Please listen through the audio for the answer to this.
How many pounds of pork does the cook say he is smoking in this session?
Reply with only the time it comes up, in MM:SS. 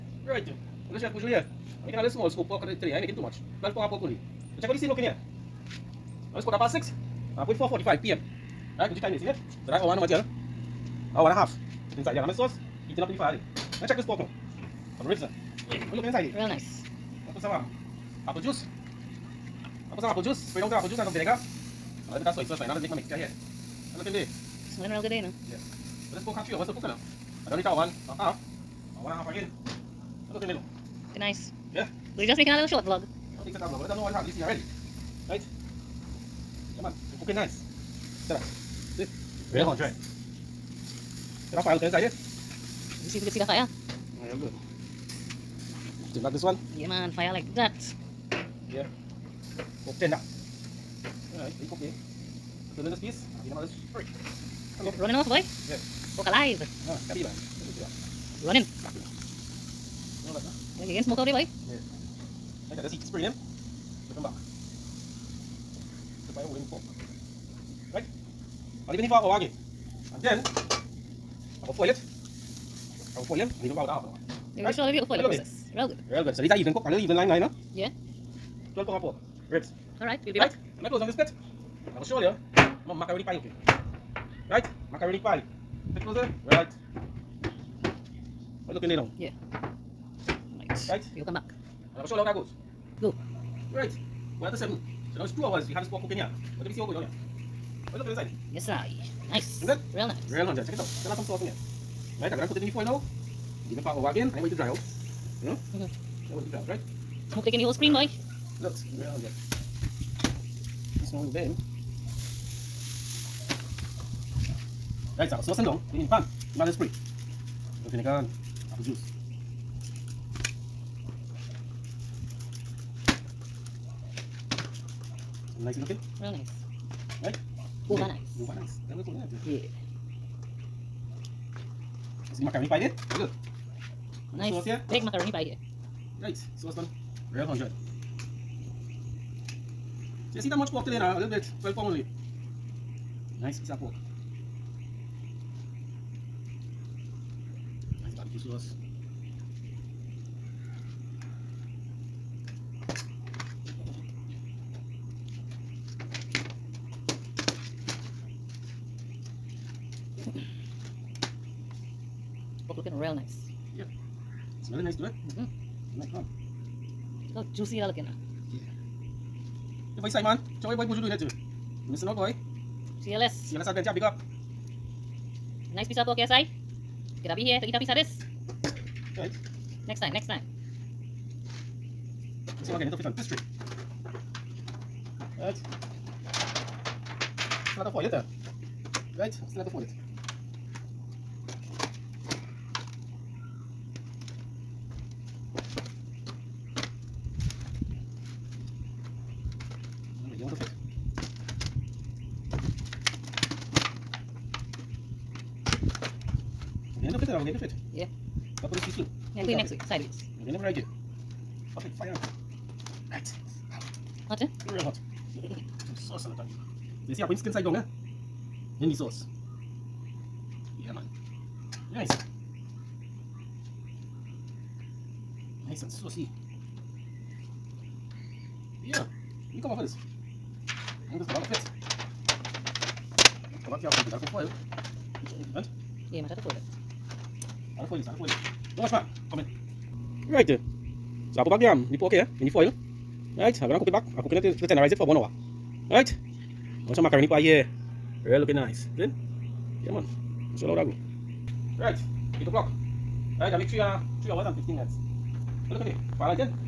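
00:03.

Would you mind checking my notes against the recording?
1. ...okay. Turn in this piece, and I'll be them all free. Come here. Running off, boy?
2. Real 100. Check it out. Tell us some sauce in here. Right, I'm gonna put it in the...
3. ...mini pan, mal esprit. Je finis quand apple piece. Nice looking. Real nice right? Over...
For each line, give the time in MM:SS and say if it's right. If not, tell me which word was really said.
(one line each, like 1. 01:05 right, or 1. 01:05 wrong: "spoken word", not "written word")
1. 00:51 right
2. 01:40 right
3. 01:55 wrong: "juice", not "piece".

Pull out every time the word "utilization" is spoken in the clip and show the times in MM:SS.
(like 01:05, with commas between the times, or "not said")
not said.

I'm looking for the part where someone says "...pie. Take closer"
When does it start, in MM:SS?
01:25.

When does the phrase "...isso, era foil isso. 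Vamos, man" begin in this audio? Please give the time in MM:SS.
03:58.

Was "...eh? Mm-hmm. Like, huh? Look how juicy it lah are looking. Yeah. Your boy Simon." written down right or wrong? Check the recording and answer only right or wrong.
right.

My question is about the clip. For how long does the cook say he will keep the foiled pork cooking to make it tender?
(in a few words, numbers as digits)
1 hour.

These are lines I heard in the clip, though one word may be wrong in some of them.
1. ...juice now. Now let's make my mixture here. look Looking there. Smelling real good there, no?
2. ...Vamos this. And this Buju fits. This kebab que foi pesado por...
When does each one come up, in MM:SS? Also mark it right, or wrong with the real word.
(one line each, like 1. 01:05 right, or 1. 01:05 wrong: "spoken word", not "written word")
1. 00:22 wrong: "sauce", not "juice"
2. 03:49 wrong: "Vamos", not "Buju".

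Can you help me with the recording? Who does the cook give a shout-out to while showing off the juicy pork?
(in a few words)
CLS Adventure.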